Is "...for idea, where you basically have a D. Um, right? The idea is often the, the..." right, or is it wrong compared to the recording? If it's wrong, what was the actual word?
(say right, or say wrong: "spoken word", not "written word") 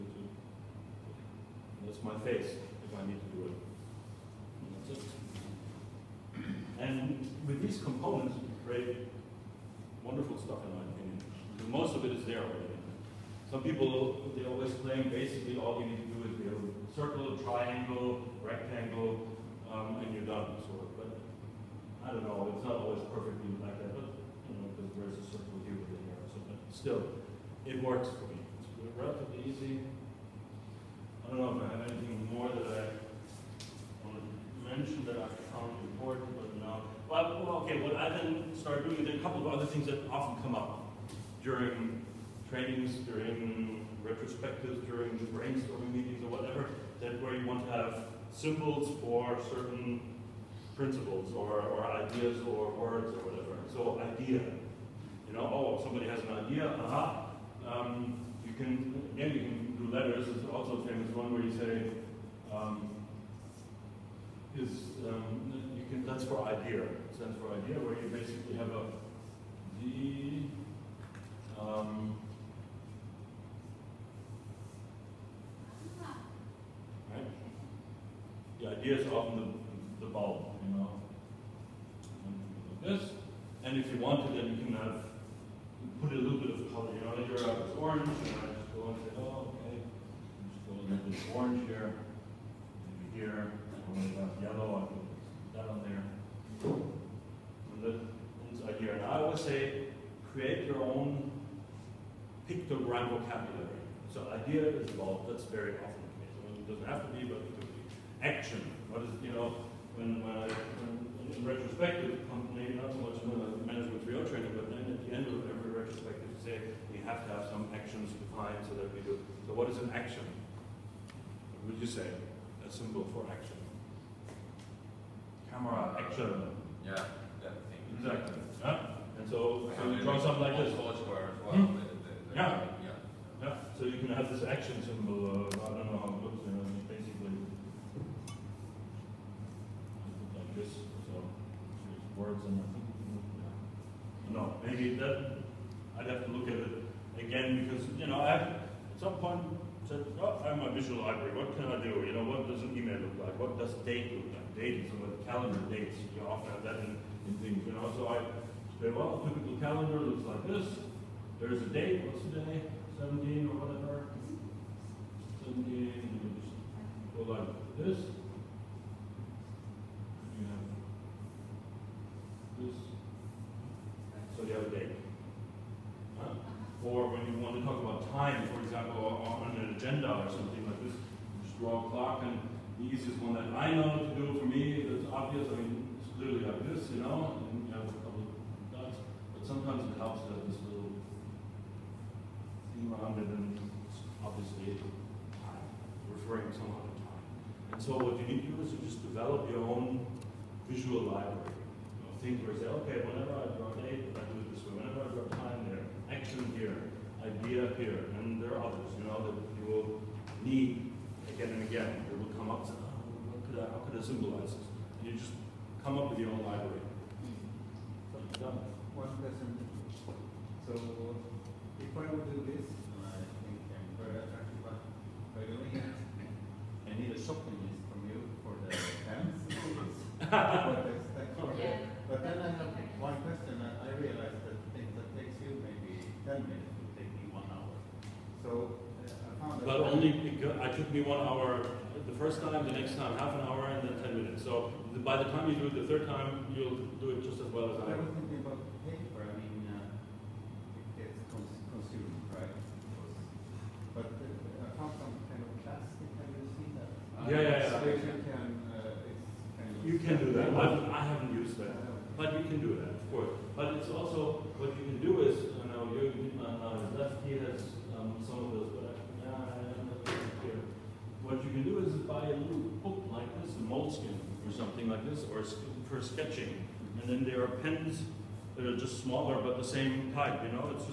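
right.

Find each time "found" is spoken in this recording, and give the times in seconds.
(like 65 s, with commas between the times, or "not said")
35 s, 239 s.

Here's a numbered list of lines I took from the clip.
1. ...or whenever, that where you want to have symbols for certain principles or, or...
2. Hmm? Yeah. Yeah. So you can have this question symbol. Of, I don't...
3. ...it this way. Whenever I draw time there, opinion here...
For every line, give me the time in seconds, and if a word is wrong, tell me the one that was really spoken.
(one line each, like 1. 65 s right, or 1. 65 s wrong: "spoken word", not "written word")
1. 46 s wrong: "whatever", not "whenever"
2. 130 s wrong: "action", not "question"
3. 204 s wrong: "action", not "opinion".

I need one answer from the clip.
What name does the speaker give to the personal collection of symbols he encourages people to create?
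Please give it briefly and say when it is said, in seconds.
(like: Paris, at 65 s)
pictogram vocabulary, at 102 s.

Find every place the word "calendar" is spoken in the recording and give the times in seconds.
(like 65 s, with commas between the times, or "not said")
155 s, 159 s.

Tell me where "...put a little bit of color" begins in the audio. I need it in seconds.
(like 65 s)
86 s.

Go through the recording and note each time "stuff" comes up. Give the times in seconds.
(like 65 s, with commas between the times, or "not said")
10 s.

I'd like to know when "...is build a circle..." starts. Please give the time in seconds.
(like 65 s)
16 s.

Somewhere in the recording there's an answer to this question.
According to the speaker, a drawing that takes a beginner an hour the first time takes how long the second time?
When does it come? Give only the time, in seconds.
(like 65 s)
243 s.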